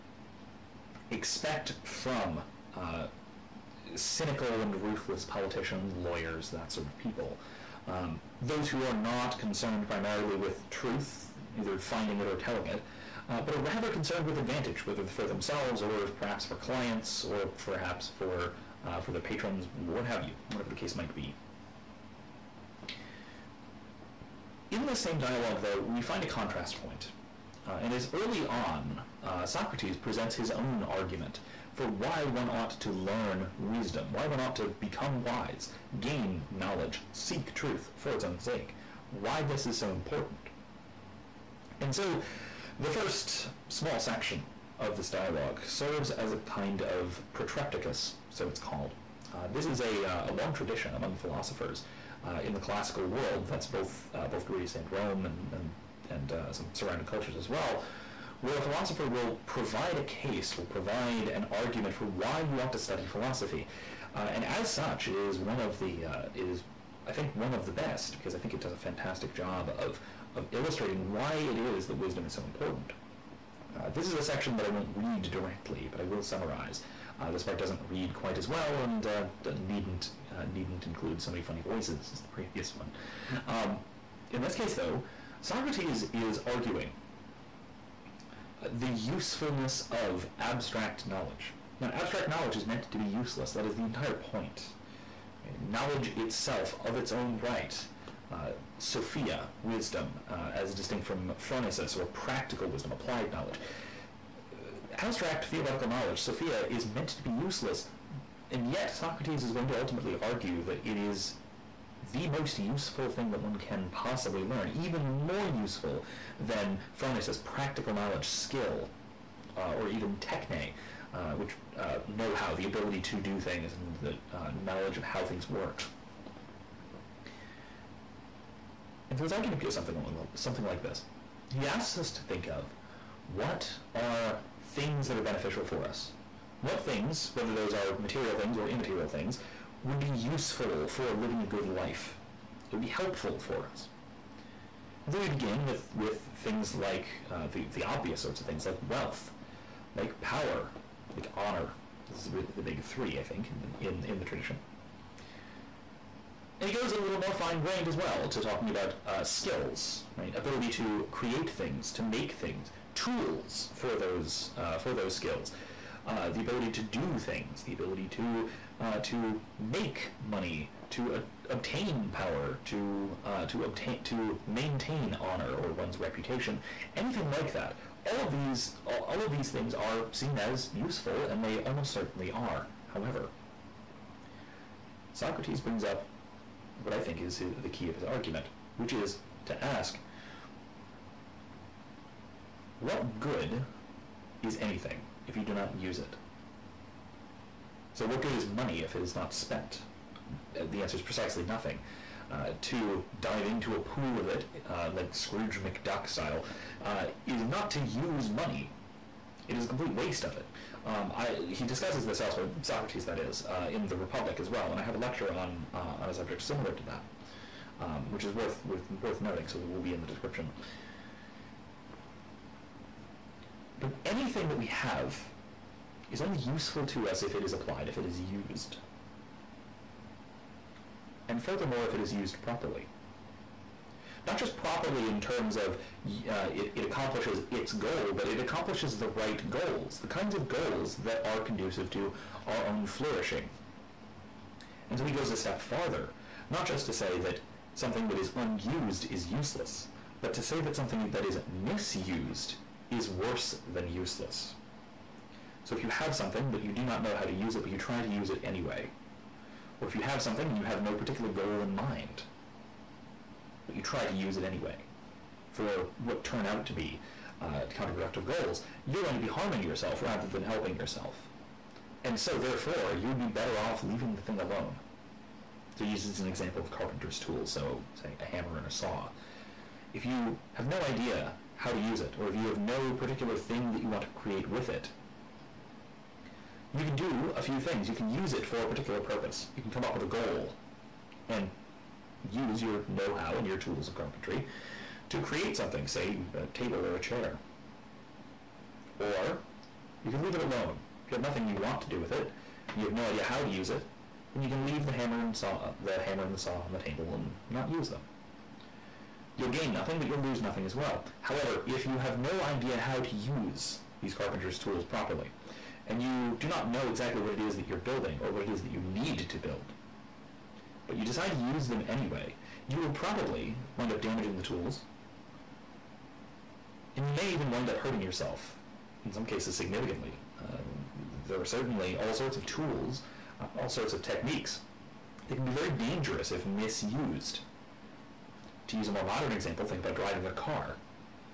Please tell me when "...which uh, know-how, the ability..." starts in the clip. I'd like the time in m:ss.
2:01.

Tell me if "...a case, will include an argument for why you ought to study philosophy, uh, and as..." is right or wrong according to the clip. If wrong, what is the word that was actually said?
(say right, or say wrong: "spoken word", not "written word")
wrong: "provide", not "include".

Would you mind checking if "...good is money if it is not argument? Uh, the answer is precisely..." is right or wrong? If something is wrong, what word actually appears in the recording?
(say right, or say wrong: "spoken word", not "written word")
wrong: "spent", not "argument".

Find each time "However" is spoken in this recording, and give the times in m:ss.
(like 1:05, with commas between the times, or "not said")
3:02, 5:11.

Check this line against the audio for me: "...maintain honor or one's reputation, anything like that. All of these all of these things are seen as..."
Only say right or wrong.
right.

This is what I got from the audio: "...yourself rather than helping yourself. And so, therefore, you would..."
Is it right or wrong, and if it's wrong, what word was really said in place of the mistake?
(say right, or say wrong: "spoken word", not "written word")
right.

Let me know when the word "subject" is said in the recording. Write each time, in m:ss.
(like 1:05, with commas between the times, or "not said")
3:36.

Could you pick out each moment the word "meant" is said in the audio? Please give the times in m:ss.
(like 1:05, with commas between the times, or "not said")
1:32, 1:46.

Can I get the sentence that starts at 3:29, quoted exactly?
It is a complete waste of it.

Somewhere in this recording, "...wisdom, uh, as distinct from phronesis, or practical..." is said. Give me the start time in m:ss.
1:39.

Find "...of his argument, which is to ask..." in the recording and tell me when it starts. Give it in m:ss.
3:07.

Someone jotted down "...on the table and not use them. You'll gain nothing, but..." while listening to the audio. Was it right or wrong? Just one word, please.
right.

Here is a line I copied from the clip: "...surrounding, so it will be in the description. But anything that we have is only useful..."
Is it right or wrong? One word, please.
wrong.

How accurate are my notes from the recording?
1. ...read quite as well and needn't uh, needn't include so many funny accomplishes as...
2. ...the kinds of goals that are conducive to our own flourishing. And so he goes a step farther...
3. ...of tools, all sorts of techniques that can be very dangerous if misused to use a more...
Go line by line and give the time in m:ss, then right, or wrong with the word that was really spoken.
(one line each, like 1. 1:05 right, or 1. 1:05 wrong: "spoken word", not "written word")
1. 1:17 wrong: "voices", not "accomplishes"
2. 3:59 right
3. 5:32 right.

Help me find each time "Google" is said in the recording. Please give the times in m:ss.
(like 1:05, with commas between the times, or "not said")
not said.